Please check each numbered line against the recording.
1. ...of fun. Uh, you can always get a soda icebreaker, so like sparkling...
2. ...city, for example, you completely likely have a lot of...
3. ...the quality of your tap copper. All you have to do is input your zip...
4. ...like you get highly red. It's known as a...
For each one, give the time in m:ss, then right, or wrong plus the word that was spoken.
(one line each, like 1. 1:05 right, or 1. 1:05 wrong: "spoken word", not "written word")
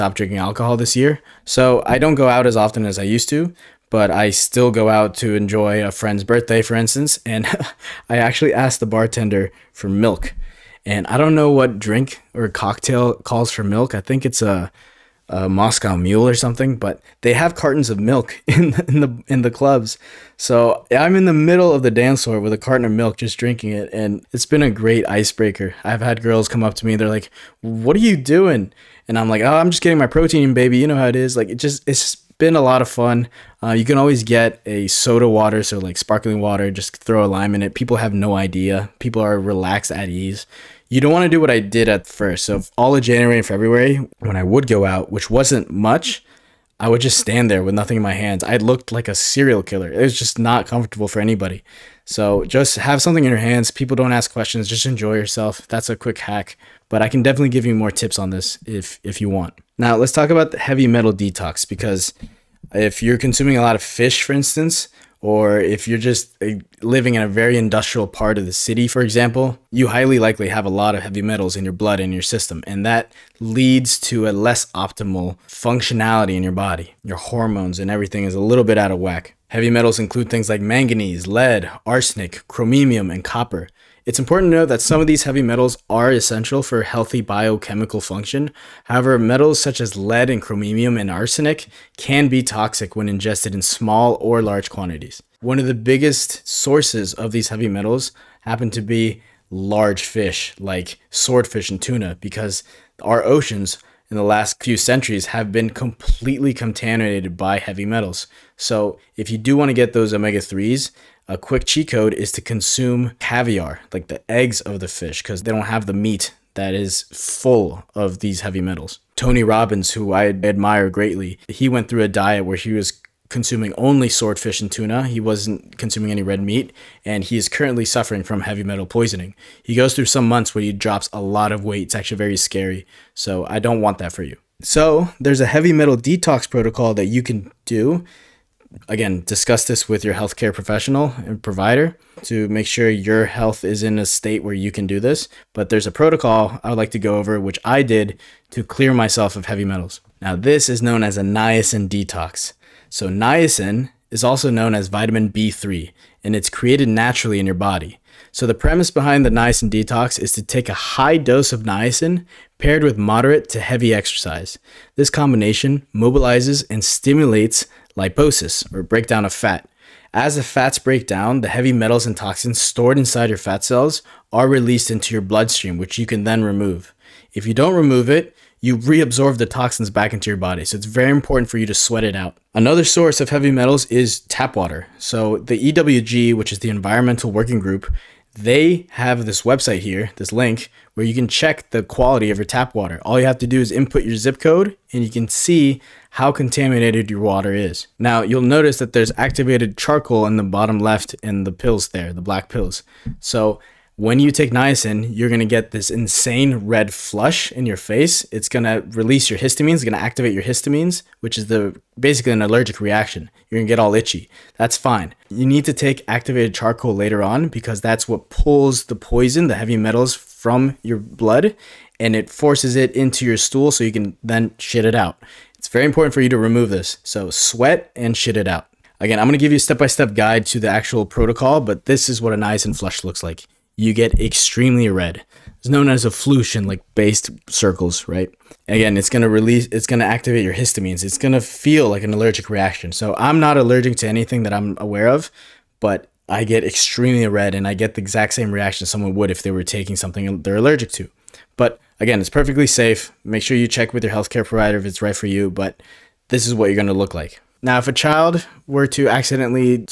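1. 0:32 wrong: "water", not "icebreaker"
2. 1:08 wrong: "highly", not "completely"
3. 3:11 wrong: "water", not "copper"
4. 3:53 wrong: "extremely", not "highly".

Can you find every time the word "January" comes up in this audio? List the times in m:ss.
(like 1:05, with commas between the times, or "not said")
0:43.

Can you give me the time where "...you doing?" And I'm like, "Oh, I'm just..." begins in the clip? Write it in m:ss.
0:28.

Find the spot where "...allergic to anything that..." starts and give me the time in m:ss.
4:03.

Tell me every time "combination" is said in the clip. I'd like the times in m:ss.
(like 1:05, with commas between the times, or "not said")
2:45.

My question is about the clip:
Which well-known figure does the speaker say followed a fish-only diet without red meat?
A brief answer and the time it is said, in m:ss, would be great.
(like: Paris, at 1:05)
Tony Robbins, at 1:59.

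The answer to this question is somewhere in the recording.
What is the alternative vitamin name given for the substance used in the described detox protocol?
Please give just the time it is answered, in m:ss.
2:34.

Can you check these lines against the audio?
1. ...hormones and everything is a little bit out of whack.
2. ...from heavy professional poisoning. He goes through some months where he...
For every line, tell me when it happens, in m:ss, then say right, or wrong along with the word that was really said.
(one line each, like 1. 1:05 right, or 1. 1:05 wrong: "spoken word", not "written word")
1. 1:17 right
2. 2:08 wrong: "metal", not "professional".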